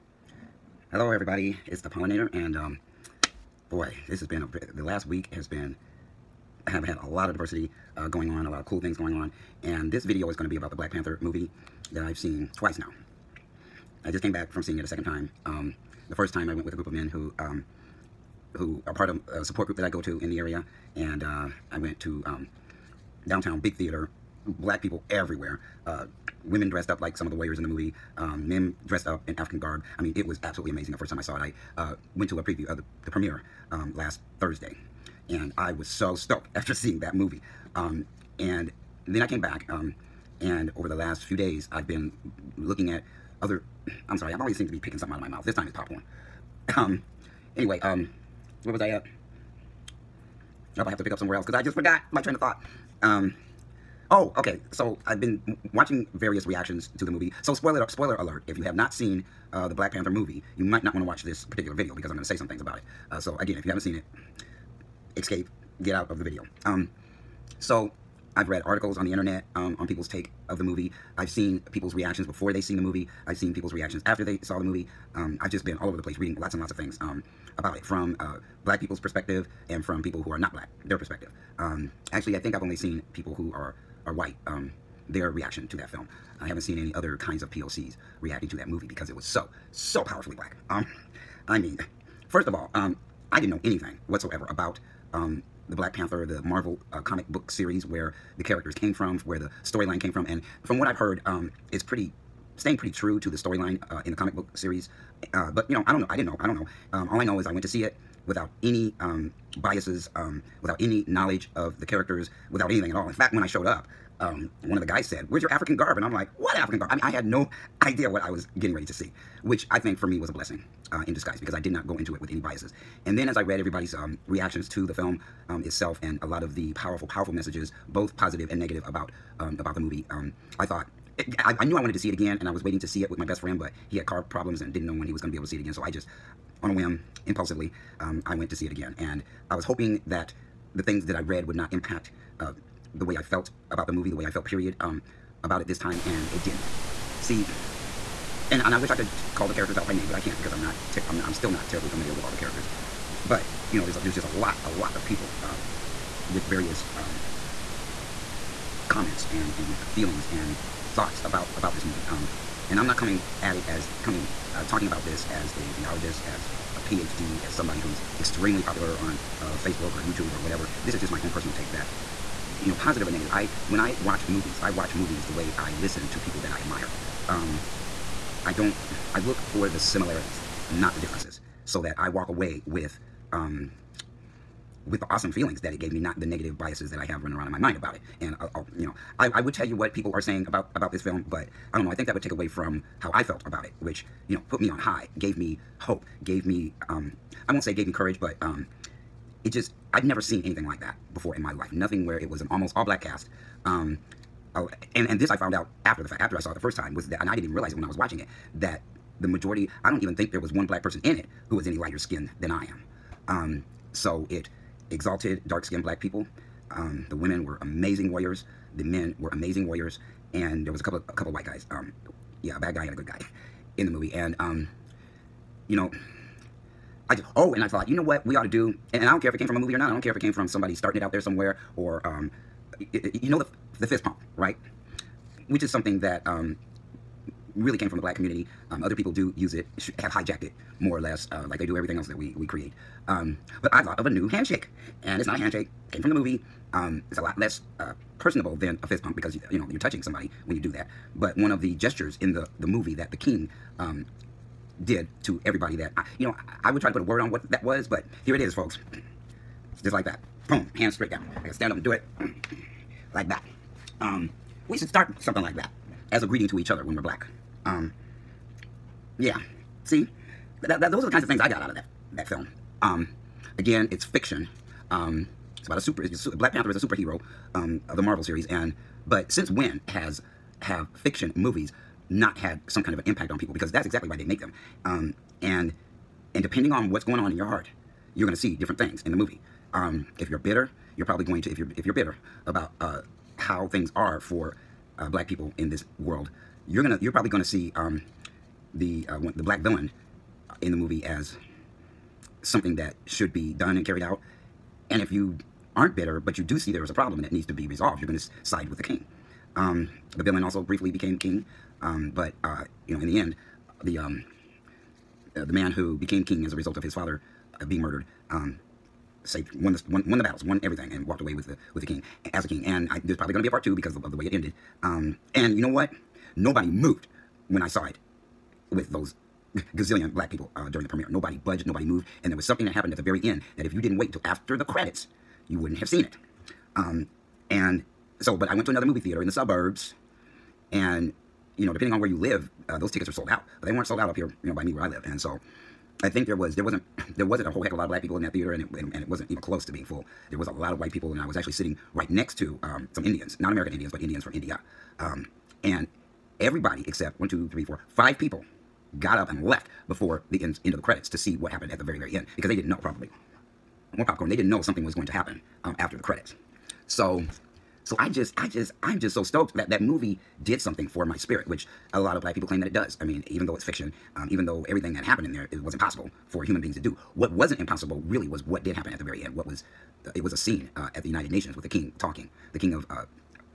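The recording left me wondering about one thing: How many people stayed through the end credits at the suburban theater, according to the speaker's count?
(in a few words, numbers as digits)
5.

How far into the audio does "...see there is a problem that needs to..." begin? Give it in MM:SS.
05:06.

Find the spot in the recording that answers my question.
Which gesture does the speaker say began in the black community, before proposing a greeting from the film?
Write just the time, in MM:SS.
03:53.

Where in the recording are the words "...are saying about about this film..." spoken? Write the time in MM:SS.
03:10.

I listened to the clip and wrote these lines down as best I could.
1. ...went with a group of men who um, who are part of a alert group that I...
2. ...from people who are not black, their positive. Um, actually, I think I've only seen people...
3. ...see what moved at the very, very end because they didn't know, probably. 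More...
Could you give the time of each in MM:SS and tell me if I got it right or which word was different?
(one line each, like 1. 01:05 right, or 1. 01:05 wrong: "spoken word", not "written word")
1. 00:16 wrong: "support", not "alert"
2. 01:19 wrong: "perspective", not "positive"
3. 06:01 wrong: "happened", not "moved".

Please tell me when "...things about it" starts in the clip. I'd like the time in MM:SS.
01:02.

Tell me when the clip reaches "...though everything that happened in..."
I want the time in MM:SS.
06:14.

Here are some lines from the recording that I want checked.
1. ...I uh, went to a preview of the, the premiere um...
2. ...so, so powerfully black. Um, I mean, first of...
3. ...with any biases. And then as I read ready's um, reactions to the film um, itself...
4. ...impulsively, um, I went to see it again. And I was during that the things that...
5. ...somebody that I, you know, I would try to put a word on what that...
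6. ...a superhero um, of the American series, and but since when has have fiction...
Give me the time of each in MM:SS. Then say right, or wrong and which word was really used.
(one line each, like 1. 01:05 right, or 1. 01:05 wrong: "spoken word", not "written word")
1. 00:31 right
2. 01:29 right
3. 02:02 wrong: "everybody", not "ready"
4. 02:17 wrong: "hoping", not "during"
5. 04:15 wrong: "everybody", not "somebody"
6. 04:36 wrong: "Marvel", not "American".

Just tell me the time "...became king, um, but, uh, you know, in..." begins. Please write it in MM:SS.
05:10.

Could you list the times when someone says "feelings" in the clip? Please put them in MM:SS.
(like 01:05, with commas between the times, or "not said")
02:39, 03:05.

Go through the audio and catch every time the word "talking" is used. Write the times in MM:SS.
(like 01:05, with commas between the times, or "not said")
02:44, 06:21.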